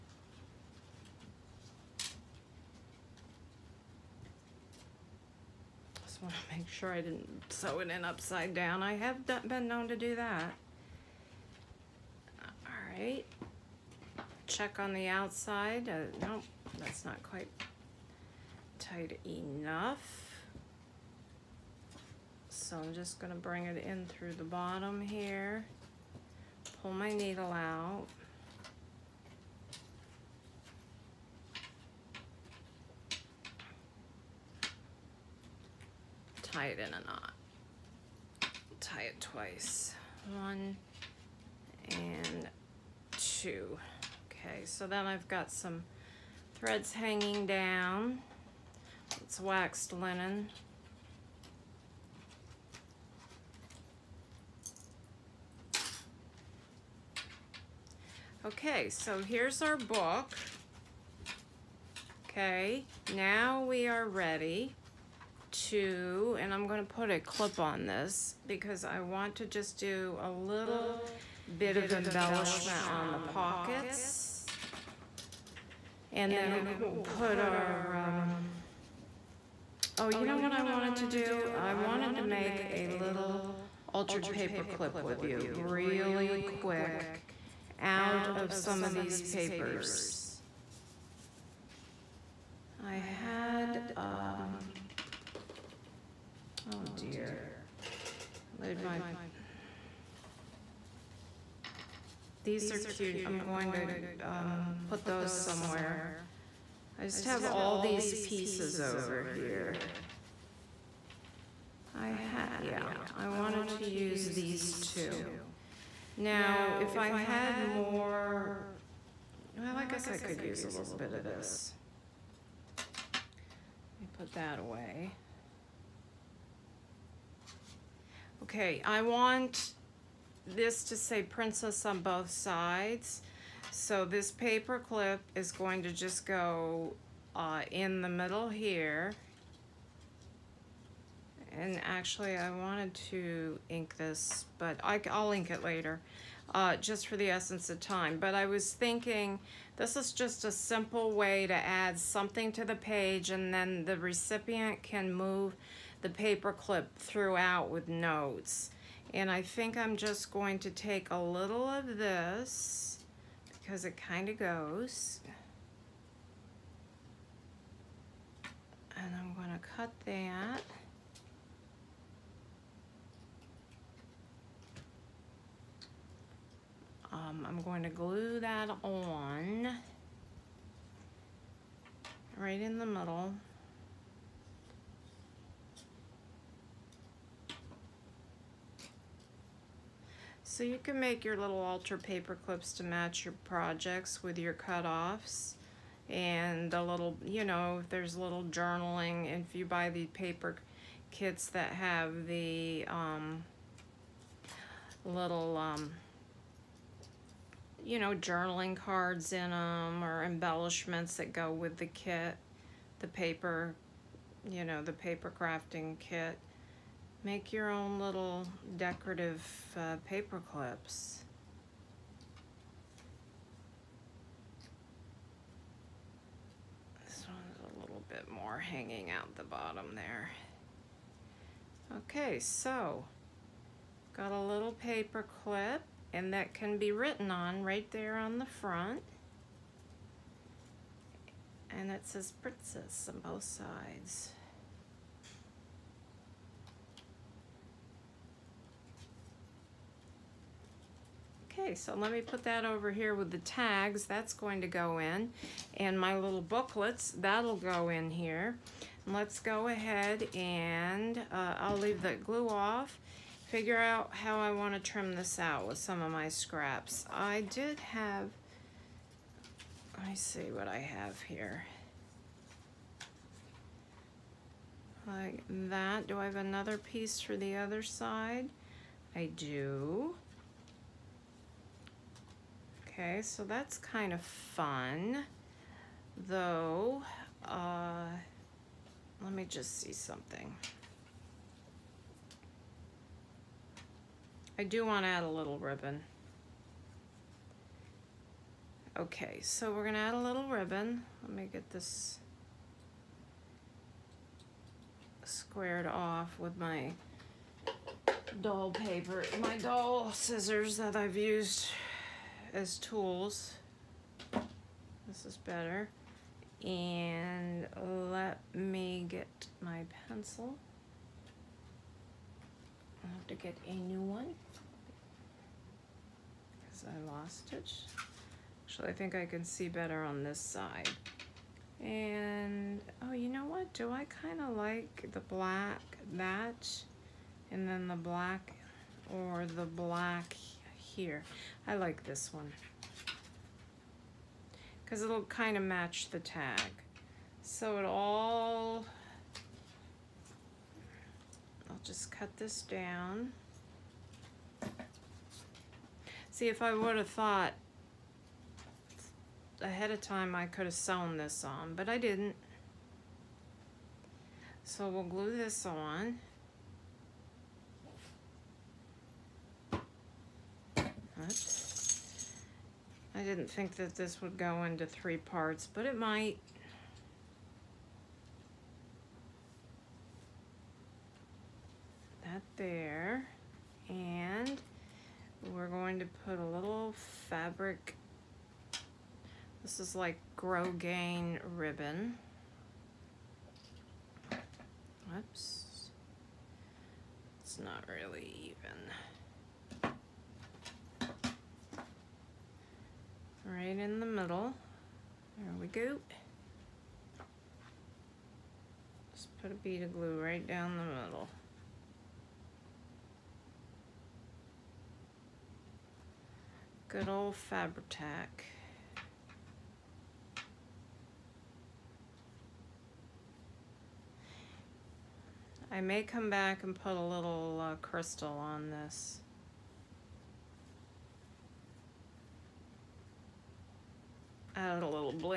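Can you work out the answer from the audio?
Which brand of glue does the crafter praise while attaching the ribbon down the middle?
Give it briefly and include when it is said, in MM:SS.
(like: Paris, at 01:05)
Fabri-Tac, at 06:57.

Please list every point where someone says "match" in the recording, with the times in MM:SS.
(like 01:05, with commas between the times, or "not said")
03:12, 05:45.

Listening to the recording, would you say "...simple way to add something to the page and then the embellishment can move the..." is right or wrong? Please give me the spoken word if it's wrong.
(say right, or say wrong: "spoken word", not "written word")
wrong: "recipient", not "embellishment".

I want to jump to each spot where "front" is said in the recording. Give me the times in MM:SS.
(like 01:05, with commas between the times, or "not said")
03:58.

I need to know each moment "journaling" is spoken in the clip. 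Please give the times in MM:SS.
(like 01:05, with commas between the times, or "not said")
03:18, 03:28.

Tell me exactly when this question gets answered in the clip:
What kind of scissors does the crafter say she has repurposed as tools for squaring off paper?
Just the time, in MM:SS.
05:09.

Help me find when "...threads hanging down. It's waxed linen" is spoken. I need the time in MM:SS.
00:46.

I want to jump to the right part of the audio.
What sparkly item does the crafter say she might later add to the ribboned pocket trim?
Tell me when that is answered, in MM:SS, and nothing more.
07:07.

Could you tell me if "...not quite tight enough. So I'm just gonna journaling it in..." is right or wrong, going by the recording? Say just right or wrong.
wrong.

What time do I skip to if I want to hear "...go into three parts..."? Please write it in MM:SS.
06:14.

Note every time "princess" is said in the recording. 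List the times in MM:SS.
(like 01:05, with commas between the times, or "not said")
02:11, 04:02.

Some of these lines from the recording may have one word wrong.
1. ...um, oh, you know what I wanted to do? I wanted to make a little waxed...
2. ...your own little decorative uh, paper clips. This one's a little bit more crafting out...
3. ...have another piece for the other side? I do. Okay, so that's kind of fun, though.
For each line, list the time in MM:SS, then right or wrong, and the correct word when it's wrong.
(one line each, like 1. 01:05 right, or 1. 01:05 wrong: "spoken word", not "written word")
1. 01:17 wrong: "altered", not "waxed"
2. 03:37 wrong: "hanging", not "crafting"
3. 04:36 right.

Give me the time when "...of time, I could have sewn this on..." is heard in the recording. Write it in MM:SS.
05:59.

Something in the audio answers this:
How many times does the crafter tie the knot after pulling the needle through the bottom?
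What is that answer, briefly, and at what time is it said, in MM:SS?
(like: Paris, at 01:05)
2, at 00:39.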